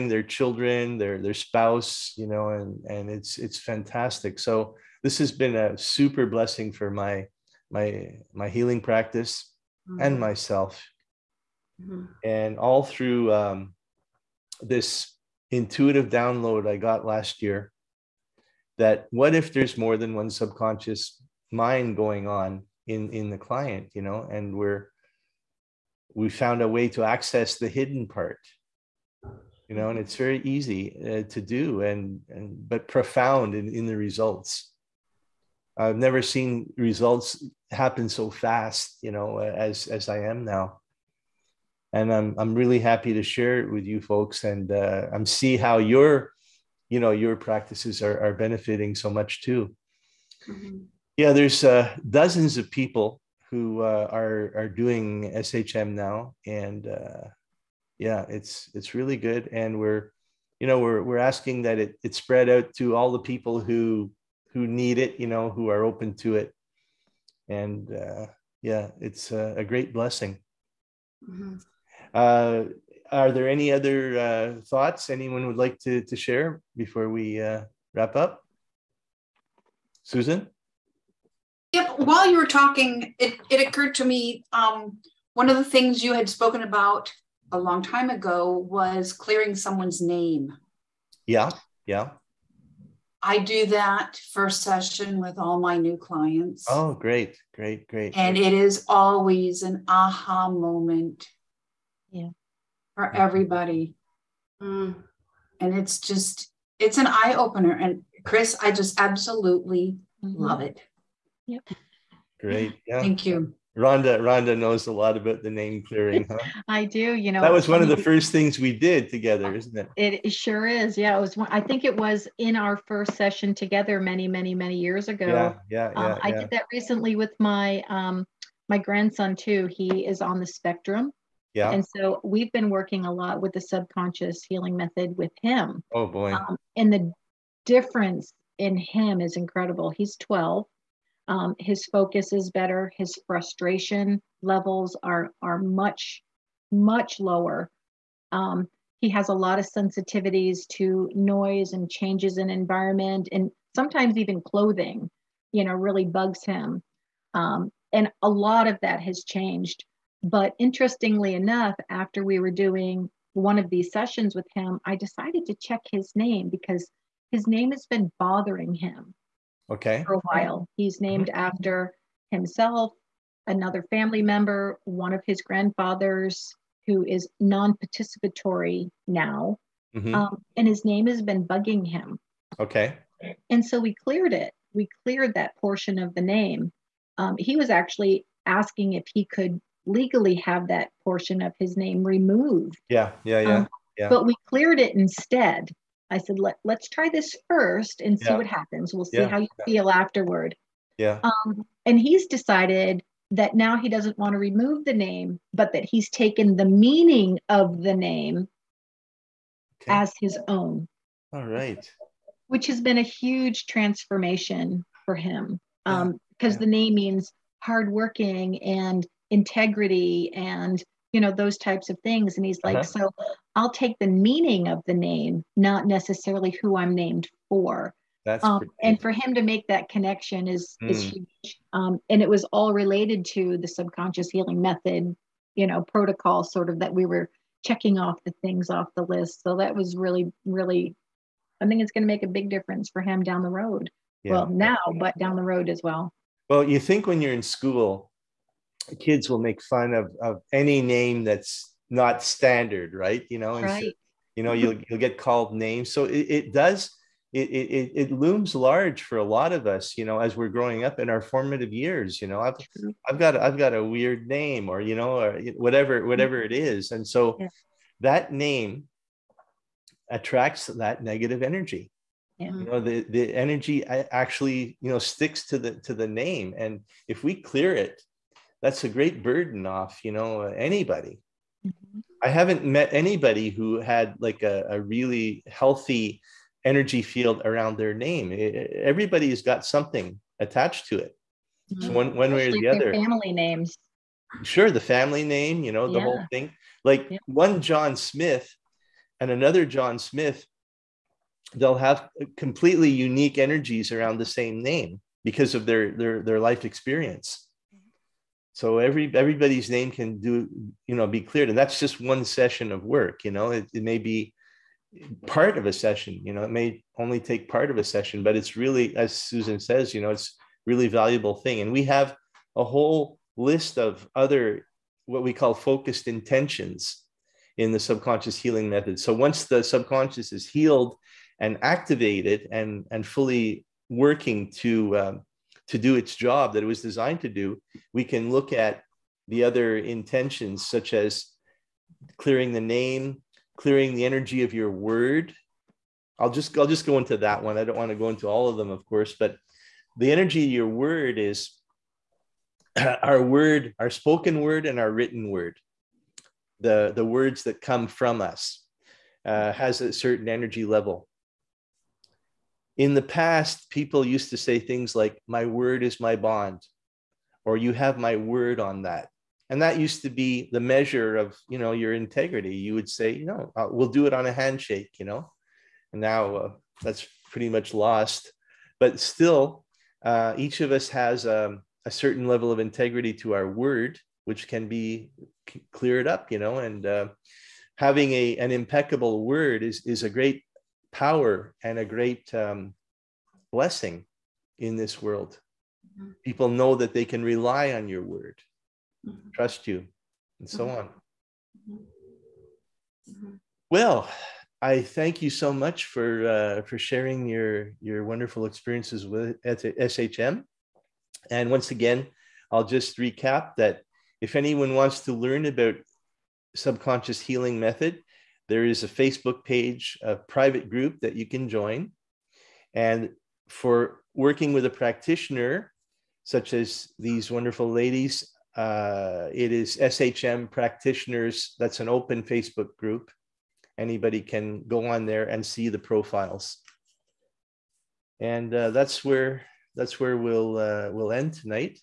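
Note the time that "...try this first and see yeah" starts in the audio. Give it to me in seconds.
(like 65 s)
196 s.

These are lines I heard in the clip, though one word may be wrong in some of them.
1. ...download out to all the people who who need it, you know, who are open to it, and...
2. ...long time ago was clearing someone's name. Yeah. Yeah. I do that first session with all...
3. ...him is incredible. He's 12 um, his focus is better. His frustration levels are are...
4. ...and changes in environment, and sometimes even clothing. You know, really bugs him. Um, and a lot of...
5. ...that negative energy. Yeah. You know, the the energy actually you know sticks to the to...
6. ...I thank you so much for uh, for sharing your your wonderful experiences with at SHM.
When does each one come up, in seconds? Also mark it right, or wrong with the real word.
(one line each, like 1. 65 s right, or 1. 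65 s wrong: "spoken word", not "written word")
1. 62 s wrong: "spread", not "download"
2. 87 s right
3. 138 s right
4. 151 s right
5. 270 s right
6. 404 s right.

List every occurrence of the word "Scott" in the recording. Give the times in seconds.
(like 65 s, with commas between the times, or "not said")
not said.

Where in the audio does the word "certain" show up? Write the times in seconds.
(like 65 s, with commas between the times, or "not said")
359 s, 381 s.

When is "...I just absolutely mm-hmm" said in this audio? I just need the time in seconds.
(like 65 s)
108 s.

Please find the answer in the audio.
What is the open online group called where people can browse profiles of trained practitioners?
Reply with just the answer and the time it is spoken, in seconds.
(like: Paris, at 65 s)
SHM practitioners, at 429 s.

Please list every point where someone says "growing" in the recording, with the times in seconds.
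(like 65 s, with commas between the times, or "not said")
260 s.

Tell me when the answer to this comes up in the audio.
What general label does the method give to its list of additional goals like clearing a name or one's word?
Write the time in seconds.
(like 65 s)
325 s.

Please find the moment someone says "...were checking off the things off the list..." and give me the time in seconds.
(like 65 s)
237 s.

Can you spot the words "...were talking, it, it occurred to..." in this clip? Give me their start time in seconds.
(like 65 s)
82 s.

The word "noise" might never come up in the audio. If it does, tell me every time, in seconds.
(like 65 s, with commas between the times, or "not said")
151 s.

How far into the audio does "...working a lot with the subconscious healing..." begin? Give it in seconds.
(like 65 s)
132 s.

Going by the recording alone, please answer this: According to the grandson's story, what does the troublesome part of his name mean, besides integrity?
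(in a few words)
hardworking.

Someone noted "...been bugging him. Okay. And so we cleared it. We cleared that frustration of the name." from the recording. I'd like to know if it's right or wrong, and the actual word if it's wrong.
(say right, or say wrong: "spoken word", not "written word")
wrong: "portion", not "frustration".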